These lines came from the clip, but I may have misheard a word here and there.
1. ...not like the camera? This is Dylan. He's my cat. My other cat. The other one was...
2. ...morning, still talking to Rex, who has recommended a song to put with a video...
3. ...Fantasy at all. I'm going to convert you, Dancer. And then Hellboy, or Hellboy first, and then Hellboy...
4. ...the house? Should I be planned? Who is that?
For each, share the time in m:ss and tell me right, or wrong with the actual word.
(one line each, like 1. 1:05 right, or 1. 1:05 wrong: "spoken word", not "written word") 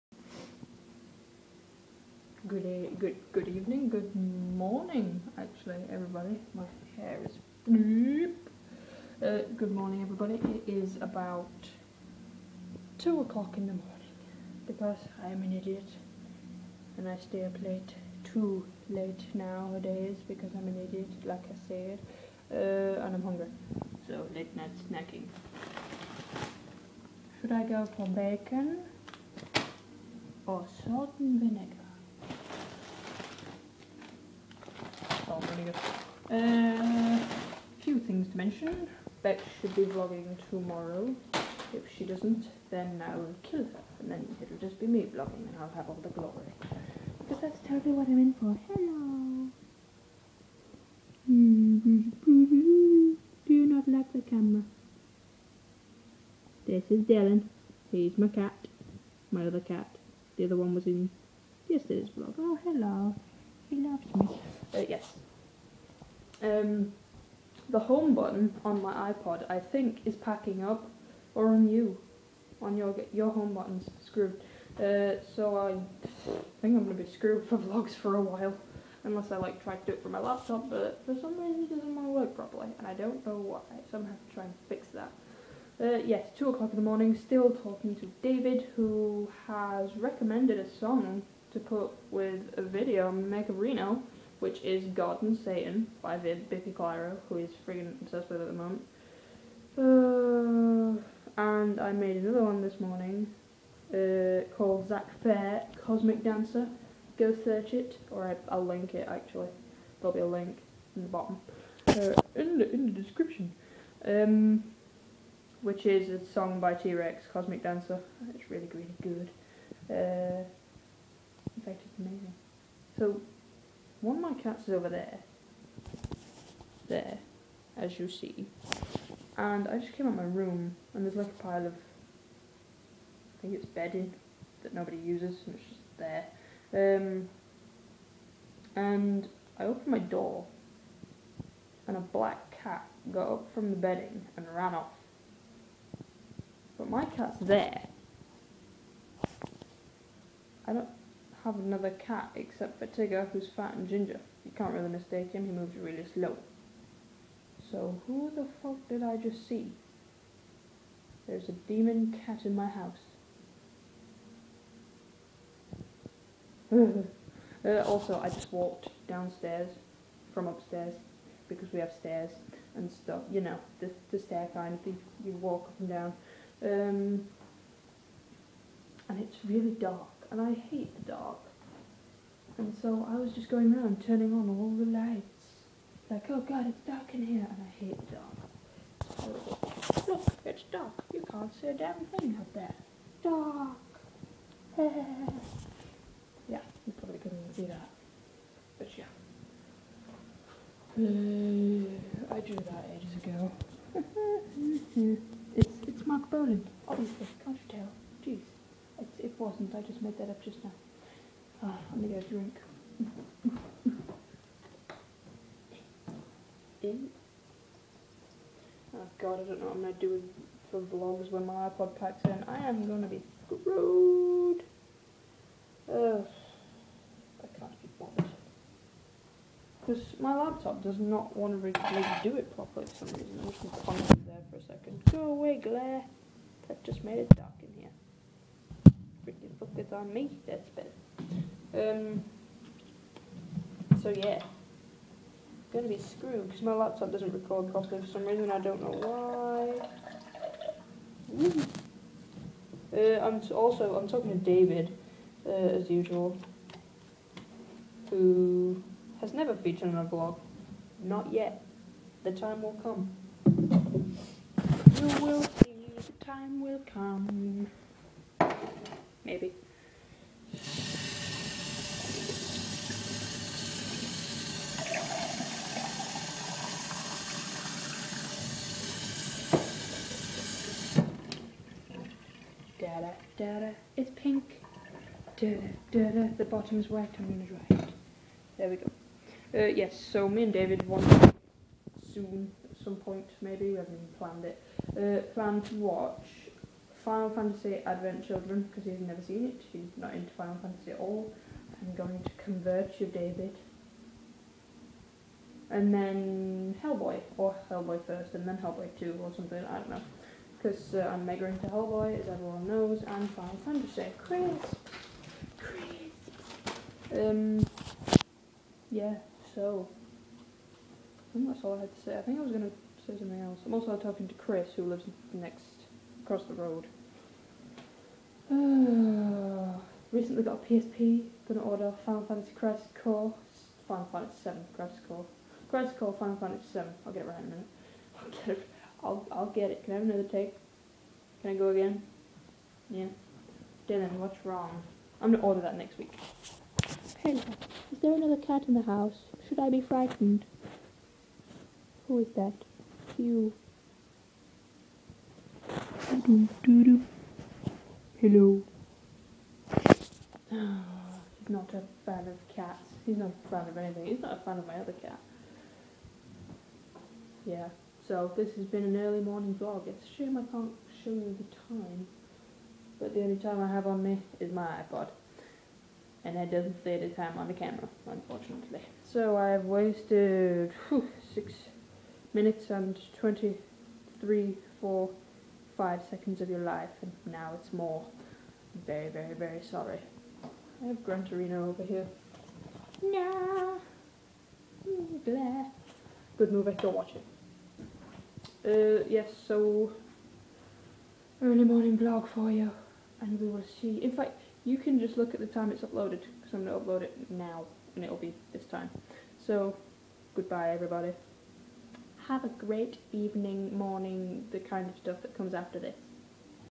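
1. 0:53 right
2. 1:26 wrong: "David", not "Rex"
3. 5:00 wrong: "David", not "Dancer"
4. 5:48 wrong: "frightened", not "planned".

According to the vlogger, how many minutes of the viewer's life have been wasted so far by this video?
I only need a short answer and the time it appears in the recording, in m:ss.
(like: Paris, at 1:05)
6, at 6:21.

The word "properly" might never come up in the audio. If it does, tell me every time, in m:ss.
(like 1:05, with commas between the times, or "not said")
1:22, 3:52, 4:07.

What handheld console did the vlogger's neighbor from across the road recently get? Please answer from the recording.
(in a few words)
PSP.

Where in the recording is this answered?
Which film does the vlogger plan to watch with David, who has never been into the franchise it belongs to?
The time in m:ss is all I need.
4:57.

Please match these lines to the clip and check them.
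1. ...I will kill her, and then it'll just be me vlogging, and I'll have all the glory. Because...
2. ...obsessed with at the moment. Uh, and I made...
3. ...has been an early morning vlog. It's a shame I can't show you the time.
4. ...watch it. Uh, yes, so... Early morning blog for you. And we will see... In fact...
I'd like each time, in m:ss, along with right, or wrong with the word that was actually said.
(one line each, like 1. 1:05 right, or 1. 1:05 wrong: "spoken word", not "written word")
1. 0:43 right
2. 1:38 right
3. 6:08 right
4. 6:36 right.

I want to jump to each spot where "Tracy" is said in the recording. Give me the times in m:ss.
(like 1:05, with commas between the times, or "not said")
not said.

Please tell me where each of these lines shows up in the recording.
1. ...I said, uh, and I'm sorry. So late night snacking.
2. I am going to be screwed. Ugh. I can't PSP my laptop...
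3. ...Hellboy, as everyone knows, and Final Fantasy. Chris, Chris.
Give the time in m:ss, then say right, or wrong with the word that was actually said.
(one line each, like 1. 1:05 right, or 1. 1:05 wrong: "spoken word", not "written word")
1. 0:21 wrong: "hungry", not "sorry"
2. 3:42 wrong: "Because", not "PSP"
3. 5:11 right.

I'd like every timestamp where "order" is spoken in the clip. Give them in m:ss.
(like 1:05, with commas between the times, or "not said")
5:31, 5:45.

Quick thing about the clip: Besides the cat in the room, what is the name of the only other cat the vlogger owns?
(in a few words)
Tigger.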